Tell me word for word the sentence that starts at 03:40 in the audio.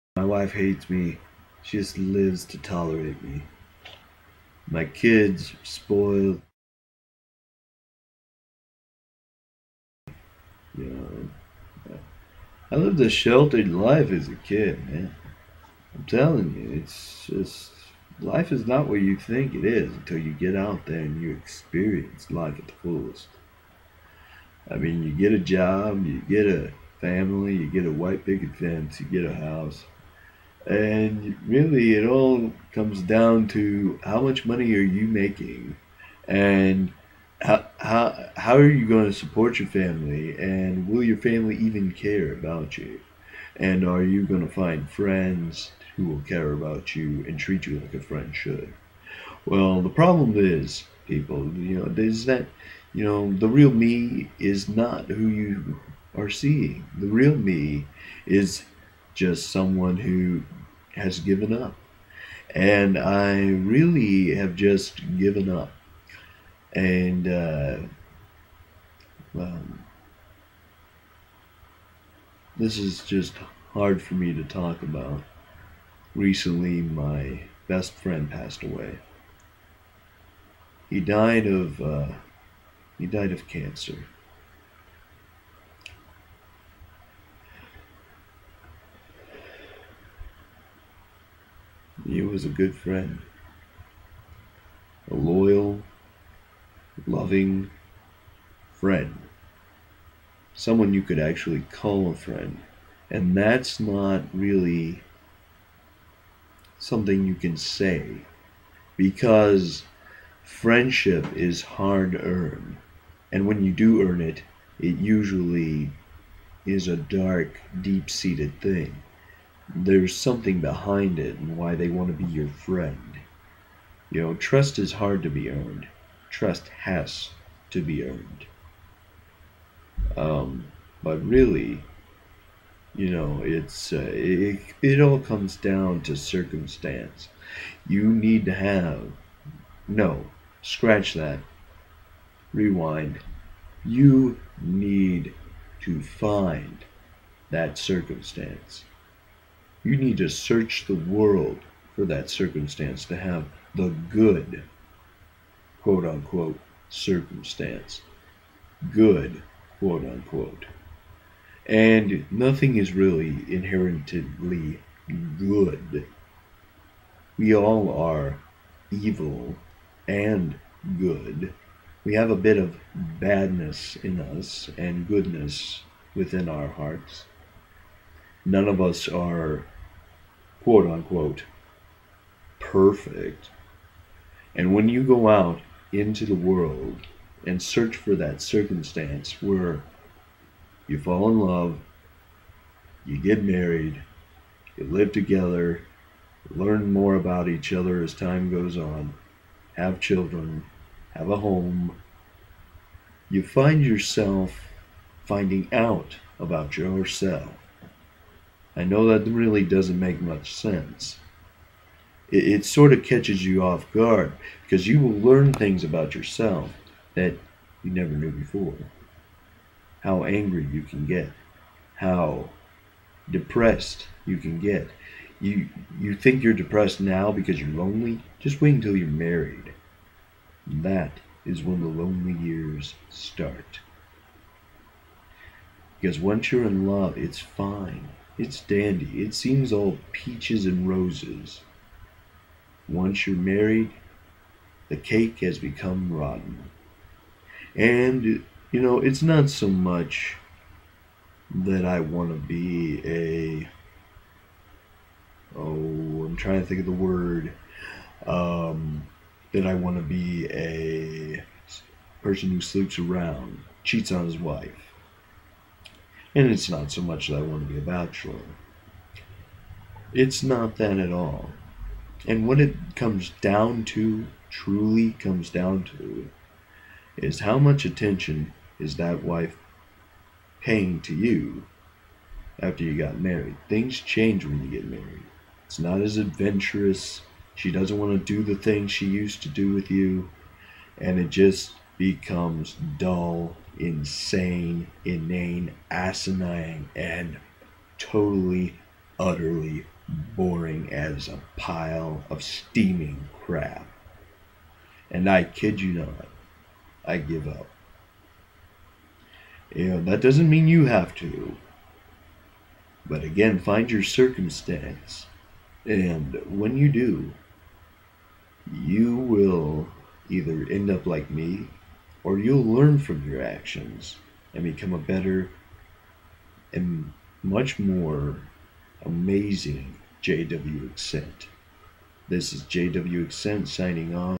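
How angry you can get, how depressed you can get.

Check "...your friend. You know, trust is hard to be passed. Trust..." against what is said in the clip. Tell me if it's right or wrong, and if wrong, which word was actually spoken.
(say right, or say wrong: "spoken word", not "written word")
wrong: "earned", not "passed".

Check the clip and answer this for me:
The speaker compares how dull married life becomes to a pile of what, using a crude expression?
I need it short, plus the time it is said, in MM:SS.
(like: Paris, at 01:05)
steaming crap, at 05:02.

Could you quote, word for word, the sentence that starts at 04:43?
Things change when you get married.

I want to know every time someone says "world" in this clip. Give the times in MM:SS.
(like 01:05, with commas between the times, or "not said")
02:30, 03:06.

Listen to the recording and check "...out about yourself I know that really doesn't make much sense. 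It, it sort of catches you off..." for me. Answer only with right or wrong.
right.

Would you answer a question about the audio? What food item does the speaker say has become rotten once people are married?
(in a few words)
cake.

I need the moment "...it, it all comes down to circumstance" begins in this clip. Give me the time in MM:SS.
02:14.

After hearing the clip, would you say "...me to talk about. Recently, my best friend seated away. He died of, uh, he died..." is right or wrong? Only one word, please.
wrong.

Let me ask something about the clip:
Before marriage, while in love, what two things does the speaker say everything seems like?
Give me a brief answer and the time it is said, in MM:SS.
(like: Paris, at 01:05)
peaches and roses, at 04:00.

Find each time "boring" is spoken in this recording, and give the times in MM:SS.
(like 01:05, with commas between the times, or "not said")
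05:00.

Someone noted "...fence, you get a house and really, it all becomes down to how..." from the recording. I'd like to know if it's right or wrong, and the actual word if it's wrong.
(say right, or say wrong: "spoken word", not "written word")
wrong: "comes", not "becomes".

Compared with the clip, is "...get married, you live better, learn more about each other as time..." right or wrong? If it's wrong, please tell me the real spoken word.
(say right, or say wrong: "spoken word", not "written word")
wrong: "together", not "better".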